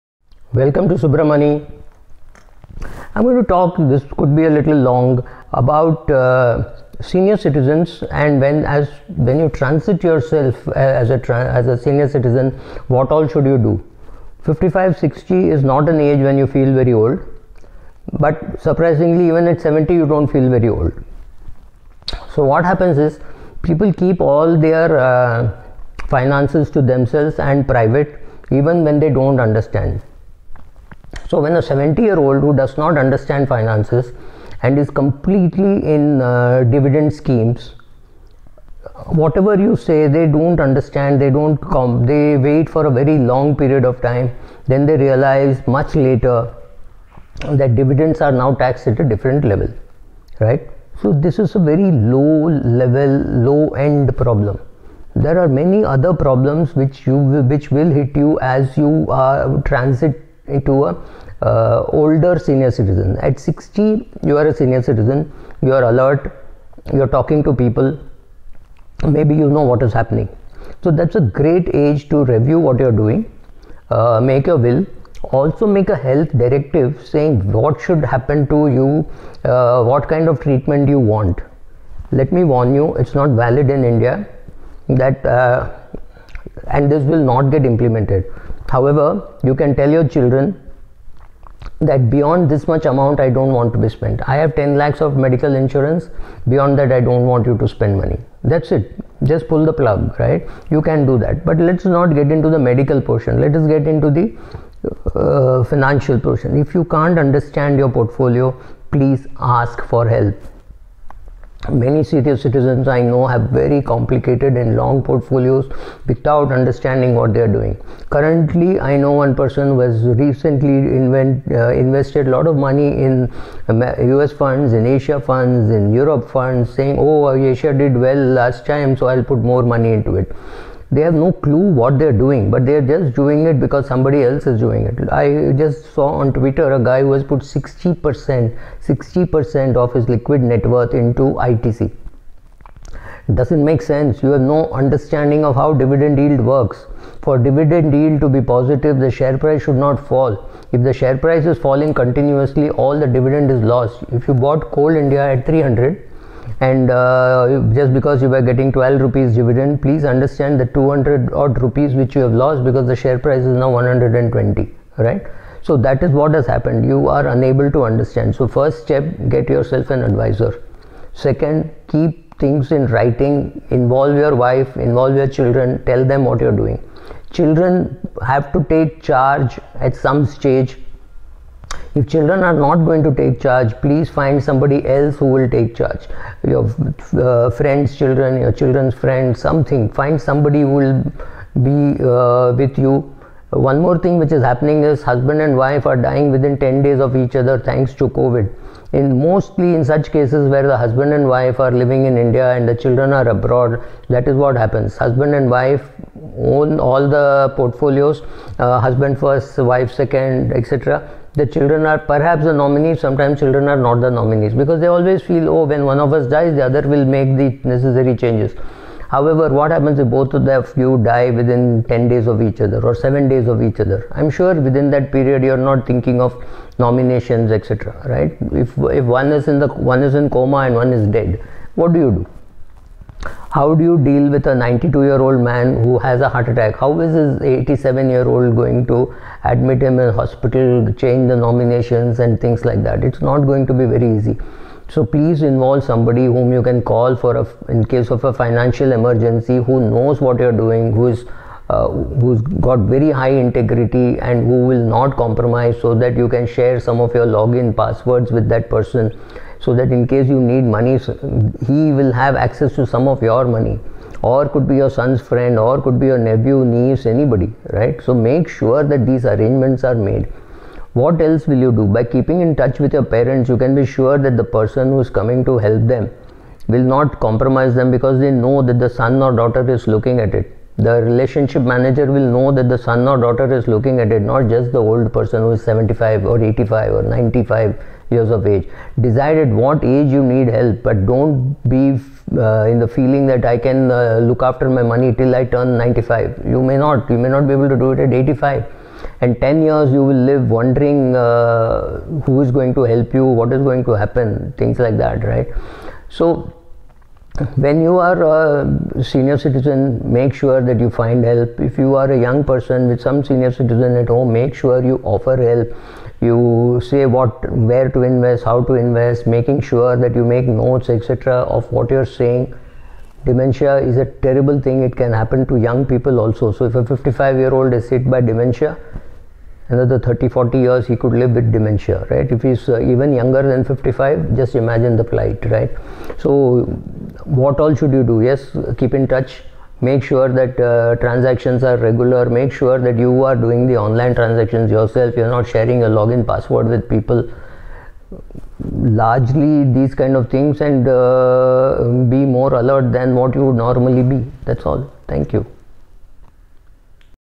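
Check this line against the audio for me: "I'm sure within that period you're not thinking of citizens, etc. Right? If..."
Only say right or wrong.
wrong.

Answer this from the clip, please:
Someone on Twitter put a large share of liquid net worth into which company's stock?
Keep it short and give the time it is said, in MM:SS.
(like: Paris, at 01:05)
ITC, at 02:21.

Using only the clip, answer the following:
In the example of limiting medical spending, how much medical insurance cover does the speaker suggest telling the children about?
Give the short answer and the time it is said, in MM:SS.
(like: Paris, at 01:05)
10 lakhs, at 01:34.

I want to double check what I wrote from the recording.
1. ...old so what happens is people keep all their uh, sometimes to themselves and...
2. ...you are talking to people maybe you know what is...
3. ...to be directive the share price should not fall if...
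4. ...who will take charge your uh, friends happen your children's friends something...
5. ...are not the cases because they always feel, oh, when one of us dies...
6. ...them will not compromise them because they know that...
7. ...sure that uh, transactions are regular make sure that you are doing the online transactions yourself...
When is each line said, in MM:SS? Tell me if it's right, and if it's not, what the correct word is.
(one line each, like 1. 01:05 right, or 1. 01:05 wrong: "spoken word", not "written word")
1. 00:20 wrong: "finances", not "sometimes"
2. 01:06 right
3. 02:28 wrong: "positive", not "directive"
4. 03:05 wrong: "children", not "happen"
5. 03:33 wrong: "nominees", not "cases"
6. 04:35 right
7. 05:40 right.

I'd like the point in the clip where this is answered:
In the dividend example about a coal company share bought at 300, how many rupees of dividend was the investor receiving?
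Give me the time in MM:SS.
02:38.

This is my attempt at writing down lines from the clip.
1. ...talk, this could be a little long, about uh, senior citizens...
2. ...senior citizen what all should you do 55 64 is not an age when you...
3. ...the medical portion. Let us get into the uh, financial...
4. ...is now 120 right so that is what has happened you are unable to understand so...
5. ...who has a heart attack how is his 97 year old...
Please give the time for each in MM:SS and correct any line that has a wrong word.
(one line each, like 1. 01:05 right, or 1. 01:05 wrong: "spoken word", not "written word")
1. 00:03 right
2. 00:11 wrong: "60", not "64"
3. 01:42 right
4. 02:43 right
5. 03:55 wrong: "87", not "97".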